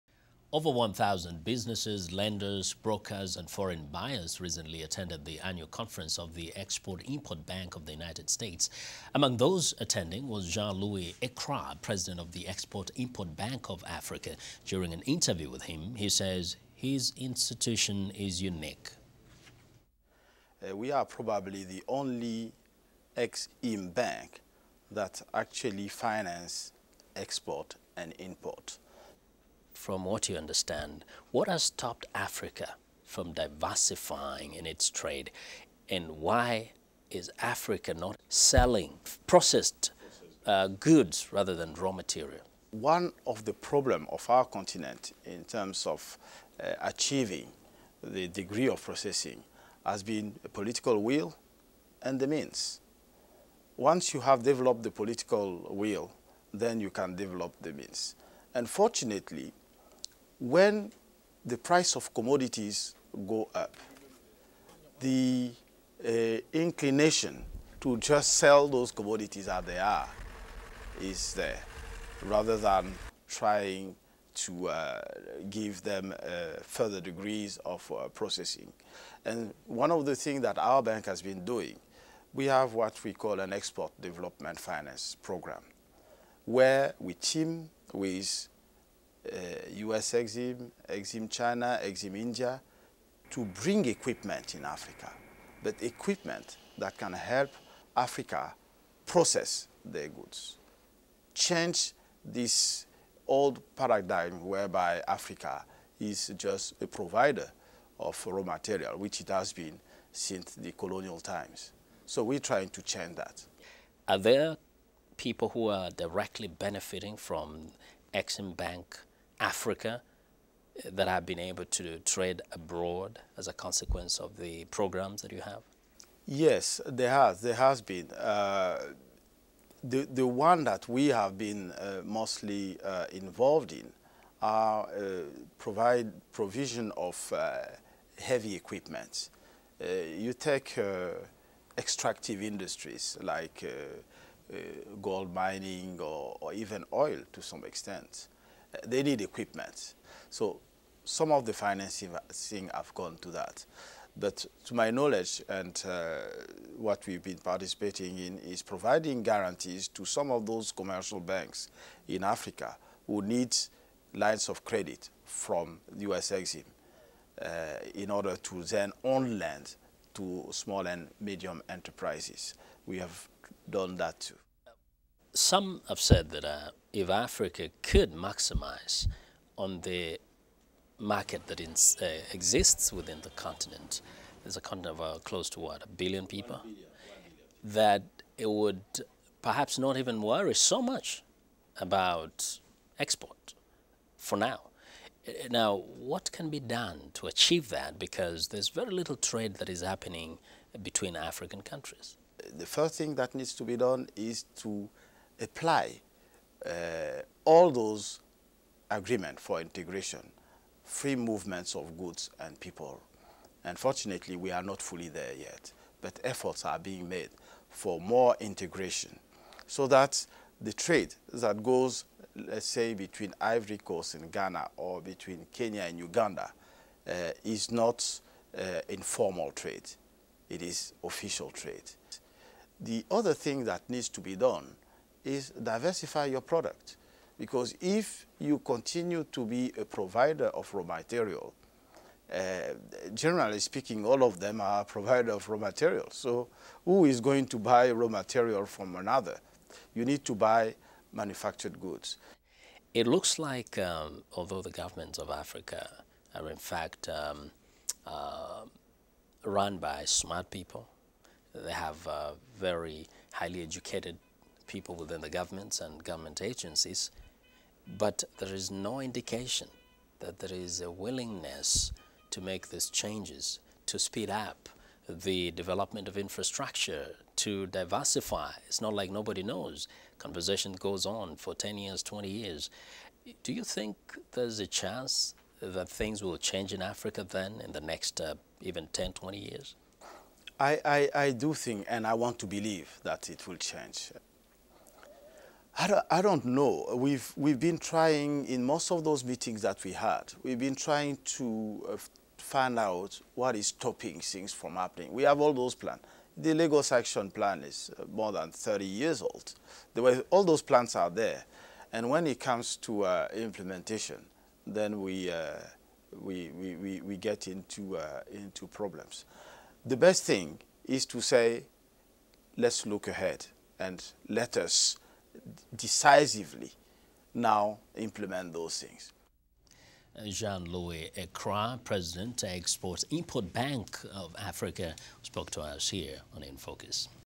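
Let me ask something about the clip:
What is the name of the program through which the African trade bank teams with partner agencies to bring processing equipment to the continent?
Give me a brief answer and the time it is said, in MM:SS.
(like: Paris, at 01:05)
export development finance program, at 01:23.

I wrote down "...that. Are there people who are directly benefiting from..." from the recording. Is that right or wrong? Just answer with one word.
right.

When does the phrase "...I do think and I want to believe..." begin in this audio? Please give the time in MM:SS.
04:51.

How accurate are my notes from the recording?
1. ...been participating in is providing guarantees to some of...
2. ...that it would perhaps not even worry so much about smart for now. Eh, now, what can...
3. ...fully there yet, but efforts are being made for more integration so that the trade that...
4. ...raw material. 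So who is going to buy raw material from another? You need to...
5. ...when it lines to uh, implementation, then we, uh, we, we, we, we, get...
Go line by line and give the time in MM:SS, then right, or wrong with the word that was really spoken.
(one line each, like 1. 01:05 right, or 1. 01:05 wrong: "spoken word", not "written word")
1. 02:37 right
2. 03:07 wrong: "export", not "smart"
3. 03:34 right
4. 04:05 right
5. 05:12 wrong: "comes", not "lines".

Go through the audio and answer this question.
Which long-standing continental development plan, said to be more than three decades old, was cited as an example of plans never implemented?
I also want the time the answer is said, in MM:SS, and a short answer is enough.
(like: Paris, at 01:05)
The Lagos Action Plan, at 05:06.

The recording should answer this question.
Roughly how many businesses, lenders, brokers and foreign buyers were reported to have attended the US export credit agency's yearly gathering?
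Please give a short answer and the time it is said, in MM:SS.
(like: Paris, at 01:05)
Over 1,000, at 00:00.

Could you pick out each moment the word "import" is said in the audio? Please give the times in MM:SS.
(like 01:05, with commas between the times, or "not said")
00:07, 00:12, 00:28, 05:33.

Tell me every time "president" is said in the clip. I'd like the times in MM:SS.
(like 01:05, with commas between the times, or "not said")
00:11, 05:31.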